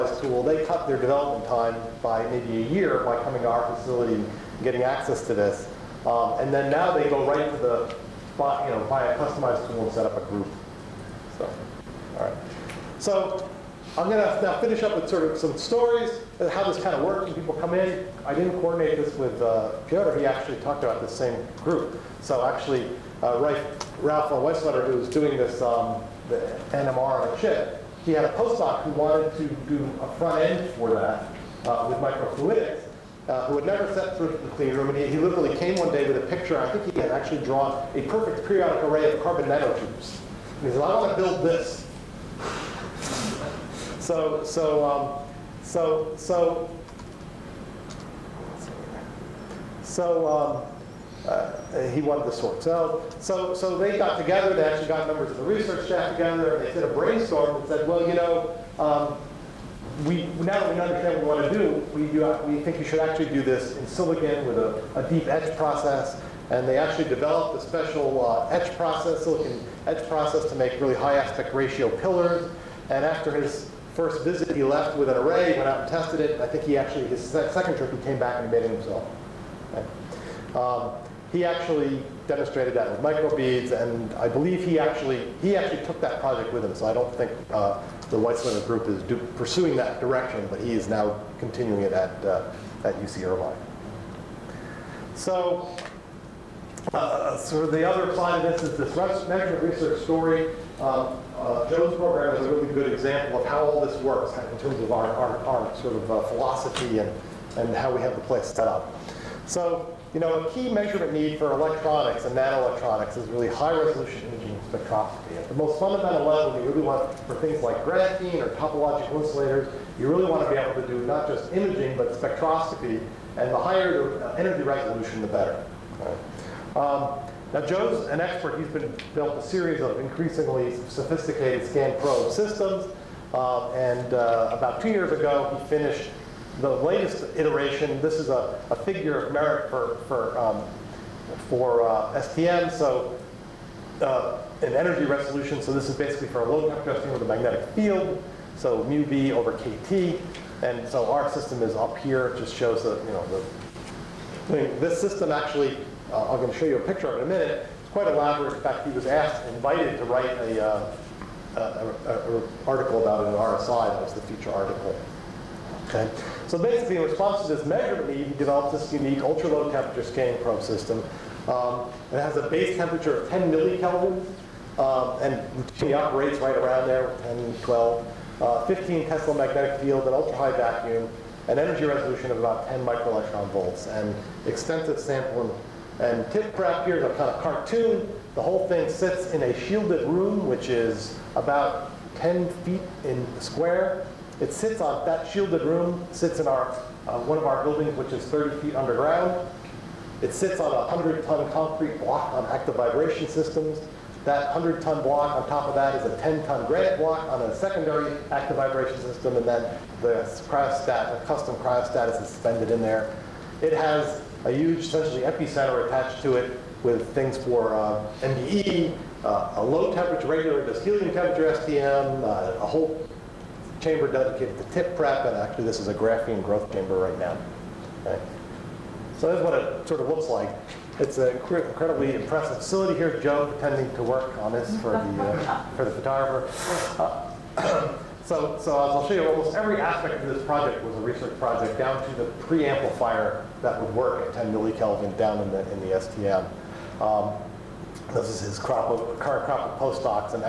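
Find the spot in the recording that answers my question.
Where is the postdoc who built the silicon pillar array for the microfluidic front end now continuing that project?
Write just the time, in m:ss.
1:32.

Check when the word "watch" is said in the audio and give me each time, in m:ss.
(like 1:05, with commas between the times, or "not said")
not said.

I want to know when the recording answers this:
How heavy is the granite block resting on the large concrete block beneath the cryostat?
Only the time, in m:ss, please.
3:26.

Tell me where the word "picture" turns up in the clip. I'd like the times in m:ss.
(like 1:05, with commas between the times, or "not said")
0:36, 2:36.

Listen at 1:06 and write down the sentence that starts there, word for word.
And they actually developed a special uh, etch process, silicon etch process, to make really high aspect ratio pillars.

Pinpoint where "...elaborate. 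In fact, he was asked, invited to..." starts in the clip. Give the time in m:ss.
2:38.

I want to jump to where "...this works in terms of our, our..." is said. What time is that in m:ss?
1:43.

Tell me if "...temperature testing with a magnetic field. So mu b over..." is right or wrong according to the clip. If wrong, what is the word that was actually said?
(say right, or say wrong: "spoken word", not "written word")
right.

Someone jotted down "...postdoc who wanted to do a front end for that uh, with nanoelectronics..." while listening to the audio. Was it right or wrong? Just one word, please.
wrong.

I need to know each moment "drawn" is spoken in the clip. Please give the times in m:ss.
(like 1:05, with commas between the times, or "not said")
0:37.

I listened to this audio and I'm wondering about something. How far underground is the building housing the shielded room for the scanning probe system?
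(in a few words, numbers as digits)
30 feet.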